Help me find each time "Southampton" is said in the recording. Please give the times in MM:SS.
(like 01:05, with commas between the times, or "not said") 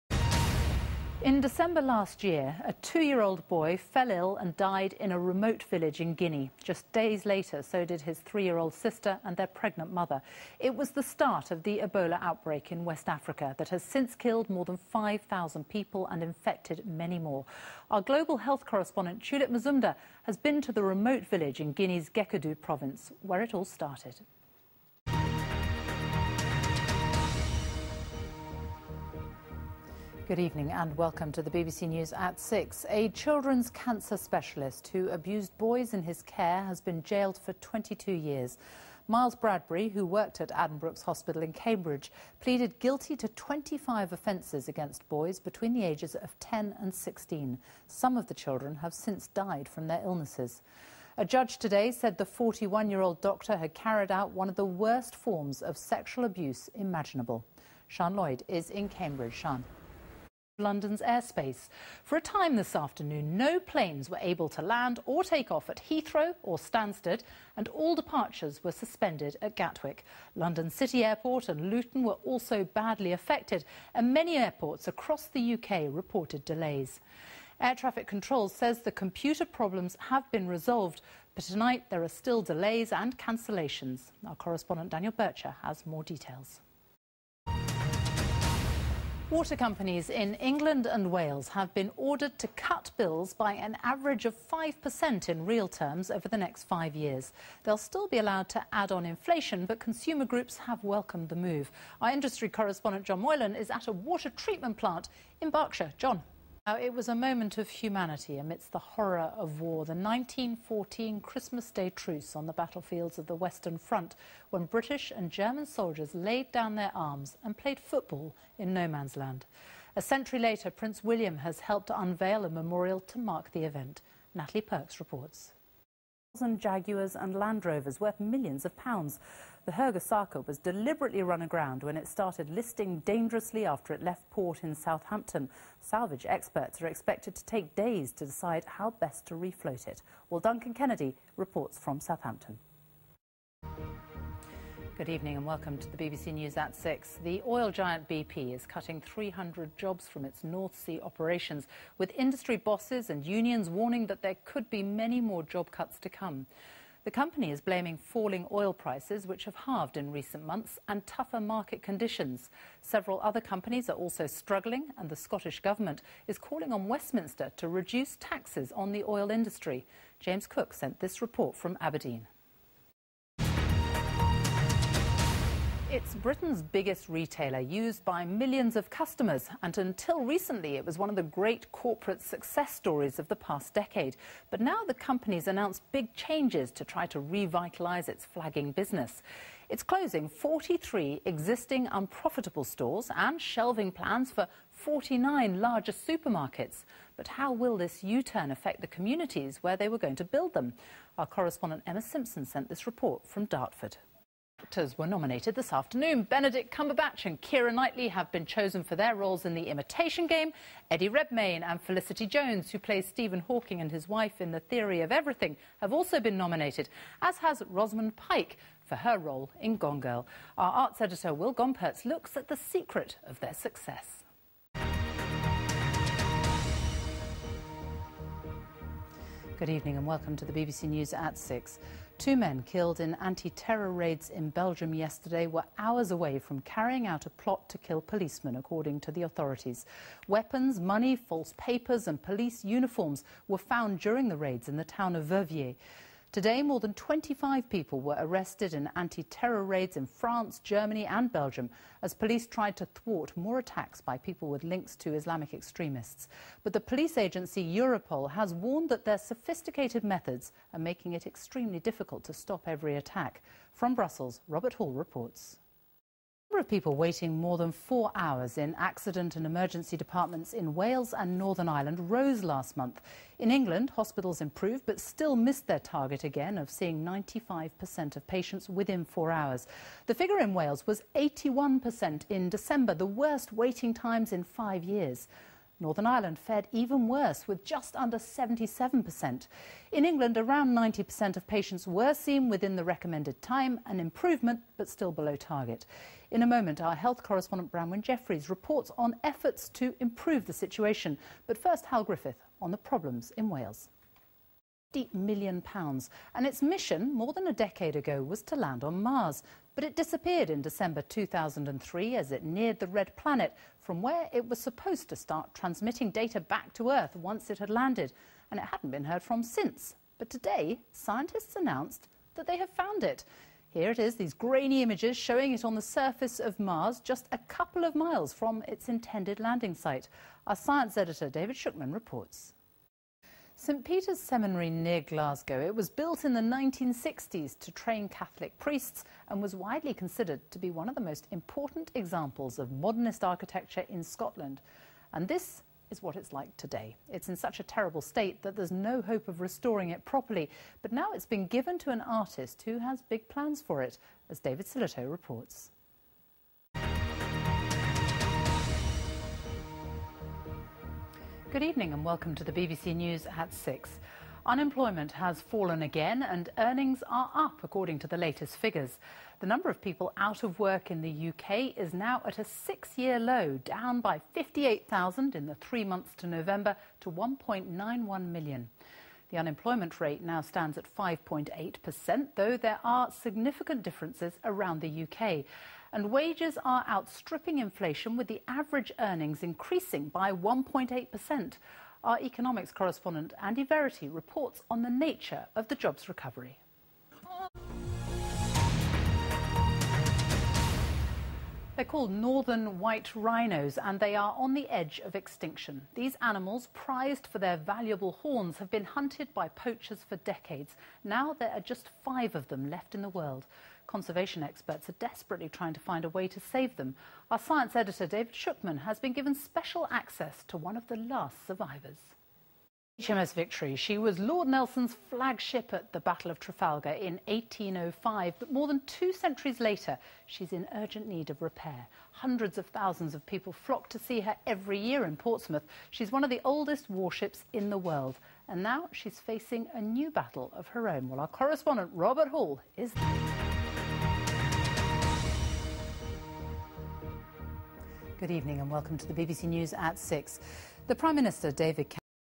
02:14, 02:21.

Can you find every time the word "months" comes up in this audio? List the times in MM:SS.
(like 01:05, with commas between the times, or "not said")
02:40, 04:32, 06:15.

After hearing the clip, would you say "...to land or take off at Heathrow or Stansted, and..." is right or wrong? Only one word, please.
right.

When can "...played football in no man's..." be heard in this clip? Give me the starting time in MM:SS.
01:57.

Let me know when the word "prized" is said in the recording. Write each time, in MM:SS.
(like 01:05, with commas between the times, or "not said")
06:46.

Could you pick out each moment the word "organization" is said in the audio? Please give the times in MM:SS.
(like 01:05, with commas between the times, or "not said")
not said.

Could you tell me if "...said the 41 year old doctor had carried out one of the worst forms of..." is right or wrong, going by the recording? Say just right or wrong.
right.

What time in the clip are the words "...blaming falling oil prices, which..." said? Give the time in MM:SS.
02:37.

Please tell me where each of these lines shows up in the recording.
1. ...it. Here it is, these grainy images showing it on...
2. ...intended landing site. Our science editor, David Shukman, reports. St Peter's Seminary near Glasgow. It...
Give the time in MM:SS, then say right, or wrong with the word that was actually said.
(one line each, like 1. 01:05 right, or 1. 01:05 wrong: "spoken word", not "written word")
1. 05:23 right
2. 05:28 right.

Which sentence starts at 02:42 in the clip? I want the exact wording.
Several other companies are also struggling, and the Scottish Government is calling on Westminster to reduce taxes on the oil industry.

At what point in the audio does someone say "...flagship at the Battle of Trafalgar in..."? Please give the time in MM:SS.
07:05.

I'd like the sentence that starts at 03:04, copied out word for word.
But now the company's announced big changes to try to revitalise its flagging business.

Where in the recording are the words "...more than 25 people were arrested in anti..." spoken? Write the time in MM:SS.
04:06.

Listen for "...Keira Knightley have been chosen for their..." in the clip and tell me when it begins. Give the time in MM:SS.
03:27.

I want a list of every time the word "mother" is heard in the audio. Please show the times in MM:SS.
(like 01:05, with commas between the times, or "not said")
00:09.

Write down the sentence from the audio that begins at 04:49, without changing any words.
In England, around 90% of patients were seen within the recommended time, an improvement, but still below target.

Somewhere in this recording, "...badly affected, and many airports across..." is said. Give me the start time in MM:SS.
01:12.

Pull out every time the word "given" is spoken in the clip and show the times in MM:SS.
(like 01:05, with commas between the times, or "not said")
05:51, 06:59.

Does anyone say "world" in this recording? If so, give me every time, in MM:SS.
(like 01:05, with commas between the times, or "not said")
06:53, 07:17.